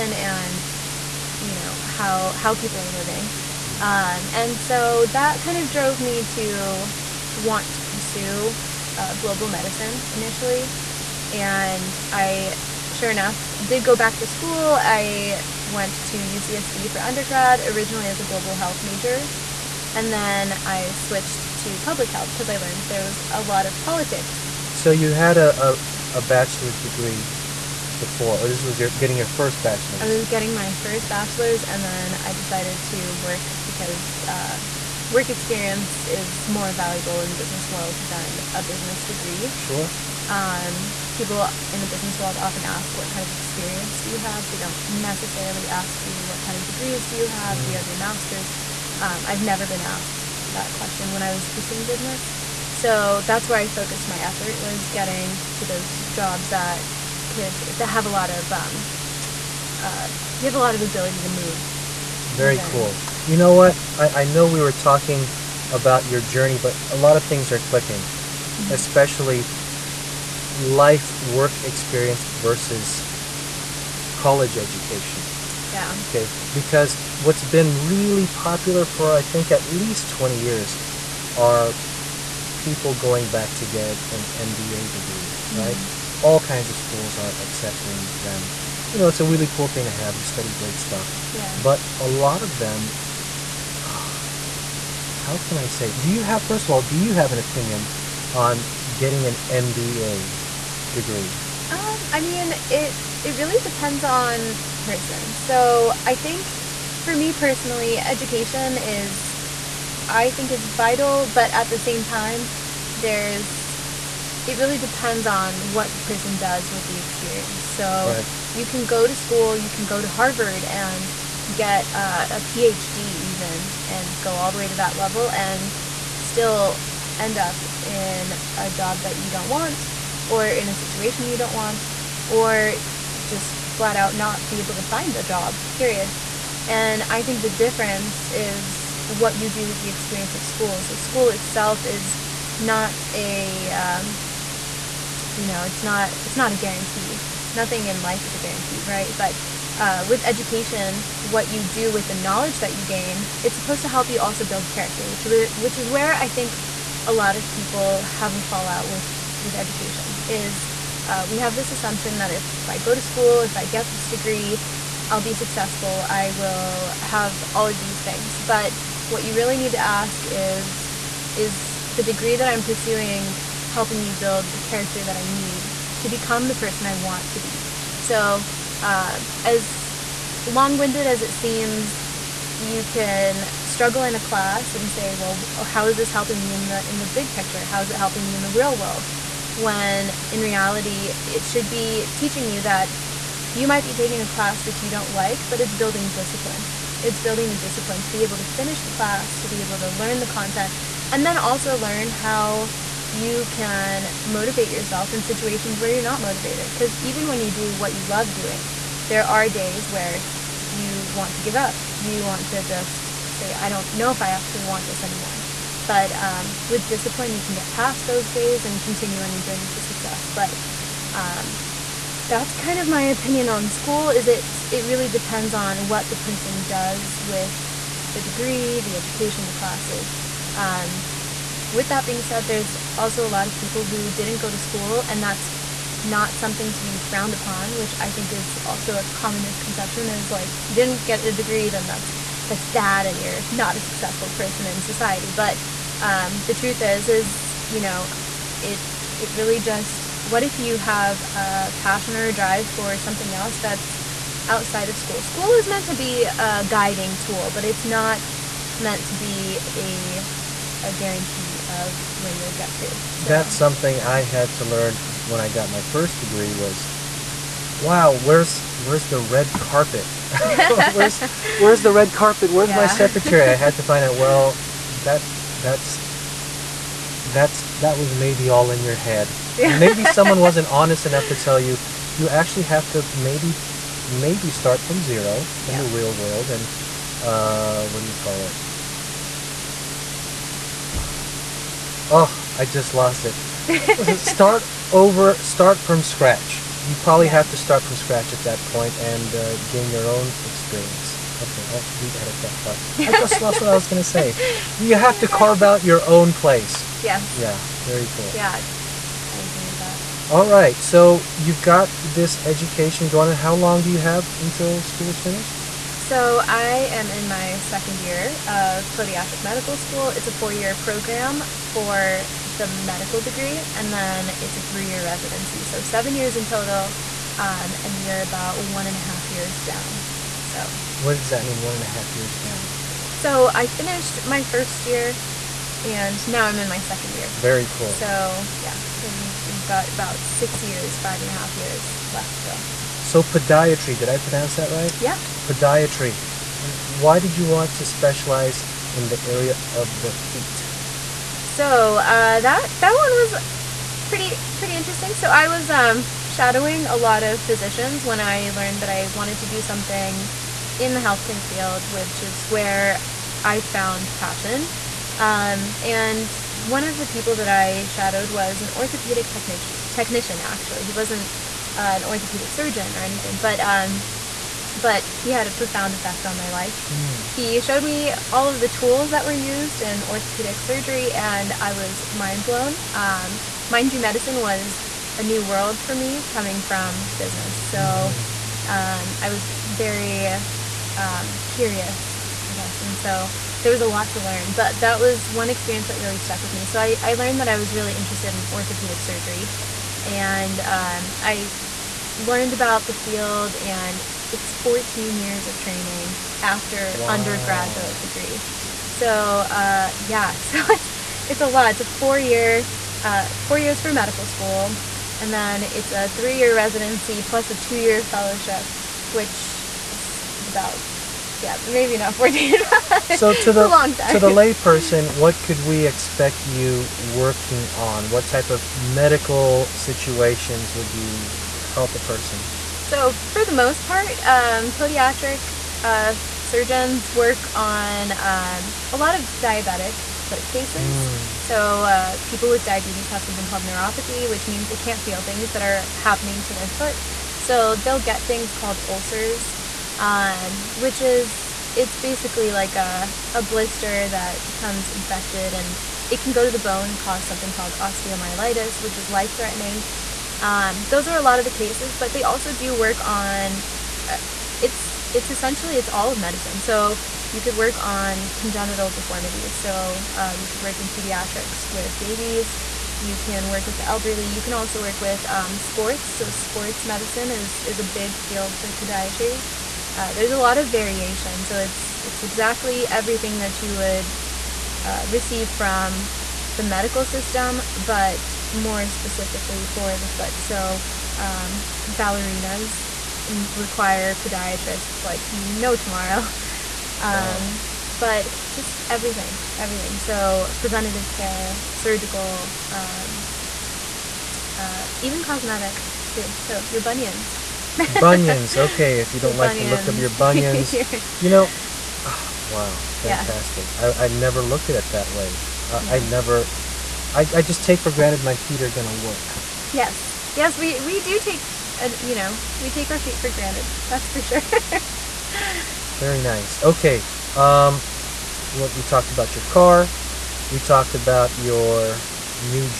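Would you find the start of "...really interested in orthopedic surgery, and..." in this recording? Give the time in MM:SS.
06:37.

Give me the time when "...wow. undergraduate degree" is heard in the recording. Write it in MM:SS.
06:46.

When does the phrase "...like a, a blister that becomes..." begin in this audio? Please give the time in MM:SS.
07:32.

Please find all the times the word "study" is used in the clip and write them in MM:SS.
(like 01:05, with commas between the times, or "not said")
01:30.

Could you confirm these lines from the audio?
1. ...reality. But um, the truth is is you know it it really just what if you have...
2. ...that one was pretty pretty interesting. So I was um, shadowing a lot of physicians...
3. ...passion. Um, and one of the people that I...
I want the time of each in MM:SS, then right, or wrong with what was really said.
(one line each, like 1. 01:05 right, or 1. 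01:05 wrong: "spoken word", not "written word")
1. 04:04 wrong: "society", not "reality"
2. 05:52 right
3. 06:04 right.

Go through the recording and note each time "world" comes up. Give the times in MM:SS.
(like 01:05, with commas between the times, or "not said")
00:37, 00:42, 03:08, 04:46, 06:25.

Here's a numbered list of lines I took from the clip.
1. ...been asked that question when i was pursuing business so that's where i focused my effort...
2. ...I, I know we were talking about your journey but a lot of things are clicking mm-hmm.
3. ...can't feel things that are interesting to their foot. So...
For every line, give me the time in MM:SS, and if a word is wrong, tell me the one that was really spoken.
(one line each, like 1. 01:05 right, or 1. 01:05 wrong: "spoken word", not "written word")
1. 00:49 right
2. 01:03 right
3. 07:24 wrong: "happening", not "interesting".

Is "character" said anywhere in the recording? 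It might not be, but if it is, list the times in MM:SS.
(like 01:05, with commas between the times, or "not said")
02:34, 02:54.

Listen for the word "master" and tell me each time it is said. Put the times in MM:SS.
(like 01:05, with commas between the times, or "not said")
00:47.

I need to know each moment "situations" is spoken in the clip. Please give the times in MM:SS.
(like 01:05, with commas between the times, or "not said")
02:10, 03:25, 07:09.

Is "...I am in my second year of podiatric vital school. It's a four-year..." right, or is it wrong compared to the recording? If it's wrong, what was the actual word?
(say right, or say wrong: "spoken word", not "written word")
wrong: "medical", not "vital".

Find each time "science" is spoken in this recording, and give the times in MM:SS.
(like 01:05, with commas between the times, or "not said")
not said.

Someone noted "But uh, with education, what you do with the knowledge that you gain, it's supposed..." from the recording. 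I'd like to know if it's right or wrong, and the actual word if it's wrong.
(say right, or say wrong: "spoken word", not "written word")
right.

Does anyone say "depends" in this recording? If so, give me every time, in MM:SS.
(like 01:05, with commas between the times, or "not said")
01:43, 01:54, 03:45.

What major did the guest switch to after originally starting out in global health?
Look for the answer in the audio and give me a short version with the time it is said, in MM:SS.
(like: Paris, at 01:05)
public health, at 00:21.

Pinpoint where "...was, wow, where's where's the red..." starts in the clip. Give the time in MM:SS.
04:26.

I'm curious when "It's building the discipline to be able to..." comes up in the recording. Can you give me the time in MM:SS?
03:17.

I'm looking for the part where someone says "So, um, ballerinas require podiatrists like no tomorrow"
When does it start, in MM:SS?
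08:10.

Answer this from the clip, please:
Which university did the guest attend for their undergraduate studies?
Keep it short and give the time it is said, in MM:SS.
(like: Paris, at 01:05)
UCSD, at 00:16.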